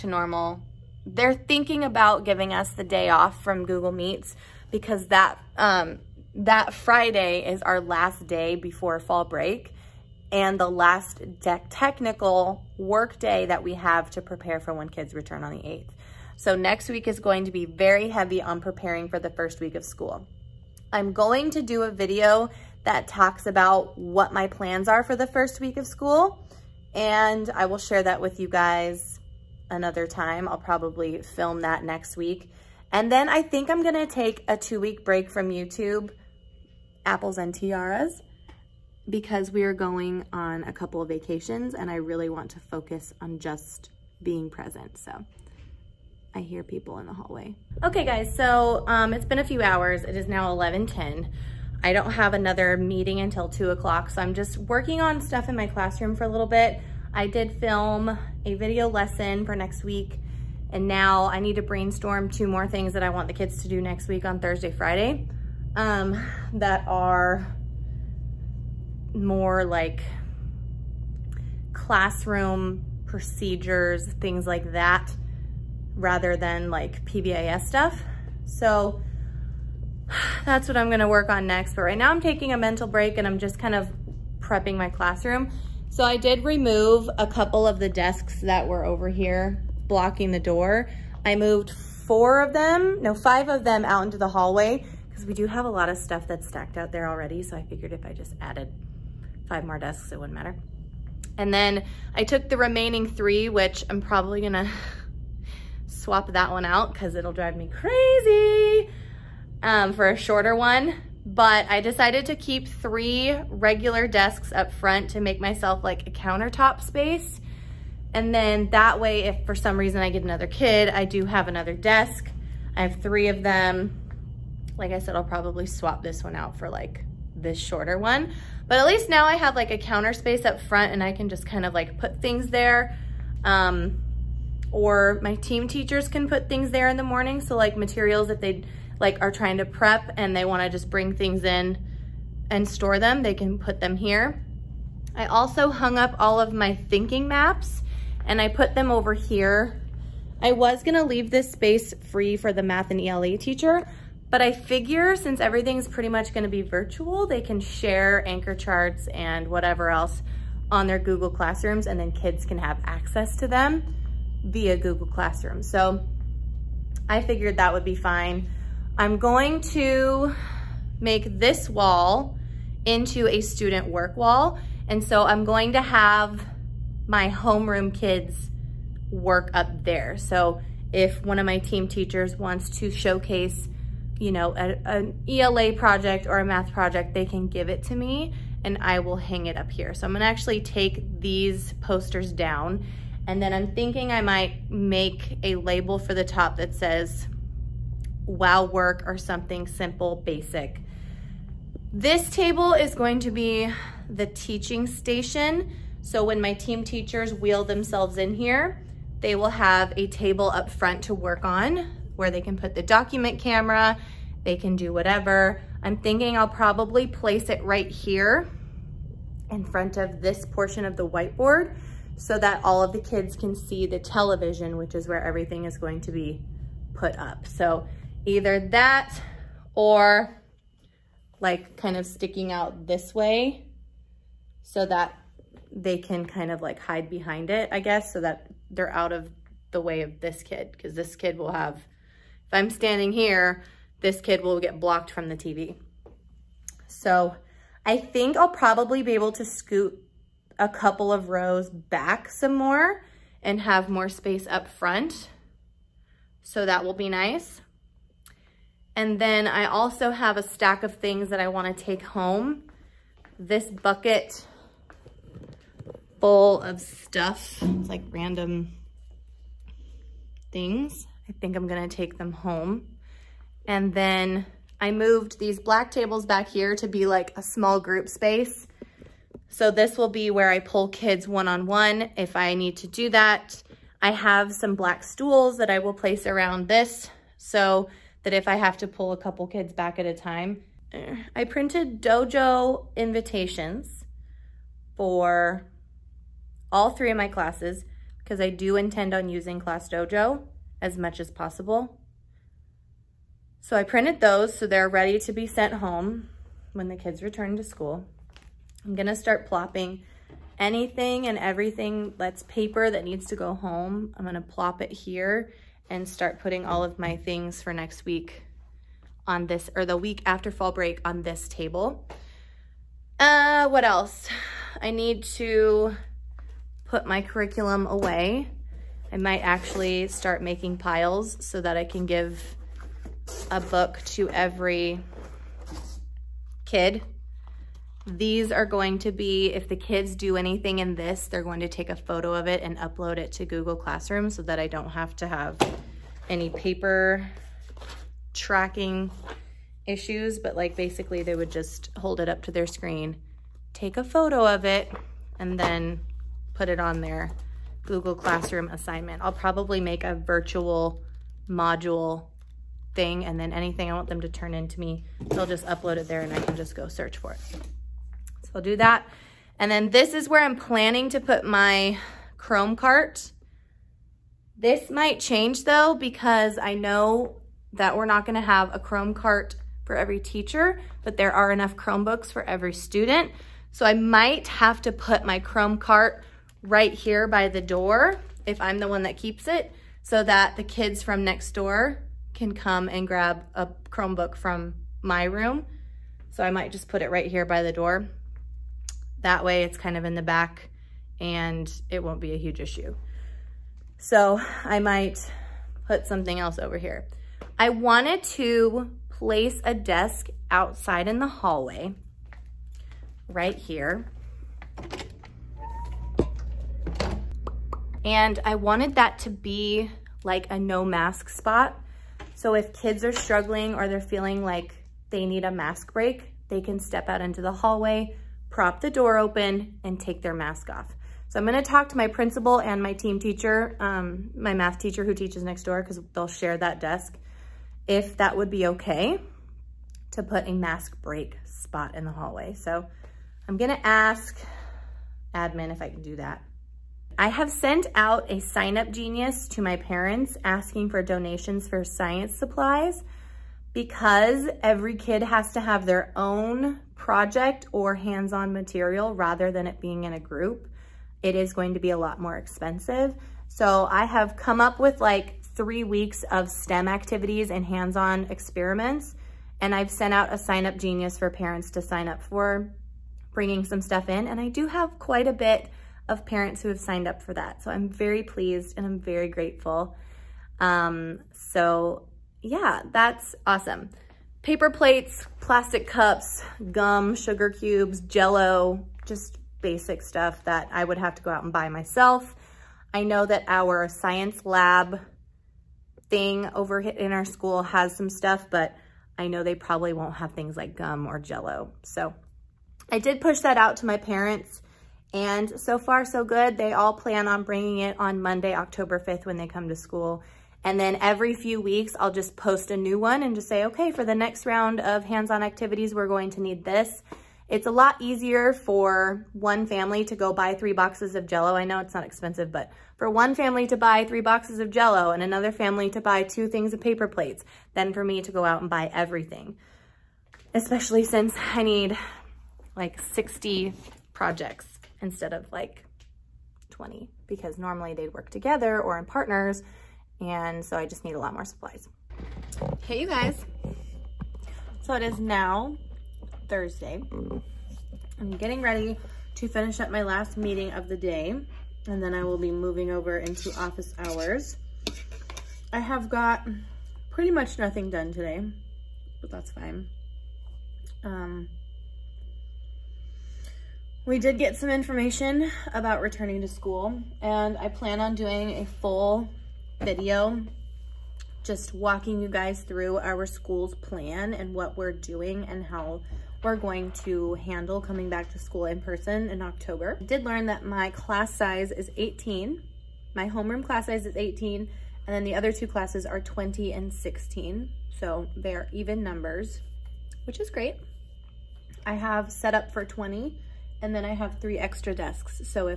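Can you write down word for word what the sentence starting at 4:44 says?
I have some black stools that I will place around this.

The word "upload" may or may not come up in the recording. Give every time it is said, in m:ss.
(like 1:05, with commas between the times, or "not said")
5:42, 6:05.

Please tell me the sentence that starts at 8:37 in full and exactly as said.
It's a lot easier for one family to go buy three boxes of jello.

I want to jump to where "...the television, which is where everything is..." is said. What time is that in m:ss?
3:43.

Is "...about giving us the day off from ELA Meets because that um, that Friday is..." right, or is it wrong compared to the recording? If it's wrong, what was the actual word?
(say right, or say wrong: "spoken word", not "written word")
wrong: "Google", not "ELA".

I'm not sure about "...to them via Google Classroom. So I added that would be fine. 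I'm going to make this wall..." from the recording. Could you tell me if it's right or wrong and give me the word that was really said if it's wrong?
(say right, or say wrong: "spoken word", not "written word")
wrong: "figured", not "added".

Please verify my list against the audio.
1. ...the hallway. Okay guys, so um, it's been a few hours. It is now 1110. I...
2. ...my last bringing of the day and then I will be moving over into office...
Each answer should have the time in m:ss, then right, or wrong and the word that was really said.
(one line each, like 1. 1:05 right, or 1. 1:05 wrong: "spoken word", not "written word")
1. 0:47 right
2. 9:09 wrong: "meeting", not "bringing".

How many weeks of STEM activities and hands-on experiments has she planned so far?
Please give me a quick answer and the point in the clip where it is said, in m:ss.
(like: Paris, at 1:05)
3, at 7:45.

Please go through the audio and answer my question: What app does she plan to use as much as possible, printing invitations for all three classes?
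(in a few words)
Class Dojo.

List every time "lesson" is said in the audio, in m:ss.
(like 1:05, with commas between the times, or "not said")
0:58.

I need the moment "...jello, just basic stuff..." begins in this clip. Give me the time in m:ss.
8:08.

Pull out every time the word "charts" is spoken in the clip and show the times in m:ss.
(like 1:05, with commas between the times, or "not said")
2:38.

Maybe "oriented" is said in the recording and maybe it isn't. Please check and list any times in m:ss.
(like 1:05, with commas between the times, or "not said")
not said.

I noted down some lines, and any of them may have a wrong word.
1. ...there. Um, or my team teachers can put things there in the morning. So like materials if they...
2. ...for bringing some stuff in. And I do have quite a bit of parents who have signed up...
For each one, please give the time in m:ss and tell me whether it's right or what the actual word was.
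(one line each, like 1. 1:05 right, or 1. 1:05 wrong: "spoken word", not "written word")
1. 2:12 right
2. 7:52 right.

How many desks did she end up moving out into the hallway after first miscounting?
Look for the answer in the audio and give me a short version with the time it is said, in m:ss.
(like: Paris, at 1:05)
5, at 1:33.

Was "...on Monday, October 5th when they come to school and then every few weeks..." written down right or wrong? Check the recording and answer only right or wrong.
right.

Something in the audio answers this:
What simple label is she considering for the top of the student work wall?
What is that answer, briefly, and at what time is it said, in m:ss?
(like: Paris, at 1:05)
Wow work, at 3:18.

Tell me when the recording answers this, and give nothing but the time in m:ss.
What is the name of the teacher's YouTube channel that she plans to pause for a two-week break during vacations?
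0:37.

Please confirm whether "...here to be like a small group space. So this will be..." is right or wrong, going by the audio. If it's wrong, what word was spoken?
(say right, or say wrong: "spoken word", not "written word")
right.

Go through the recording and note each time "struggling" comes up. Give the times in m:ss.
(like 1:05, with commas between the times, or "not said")
7:03.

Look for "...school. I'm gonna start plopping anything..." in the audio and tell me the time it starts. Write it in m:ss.
5:07.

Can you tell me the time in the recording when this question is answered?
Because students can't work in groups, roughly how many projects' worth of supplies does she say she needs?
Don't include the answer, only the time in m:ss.
8:53.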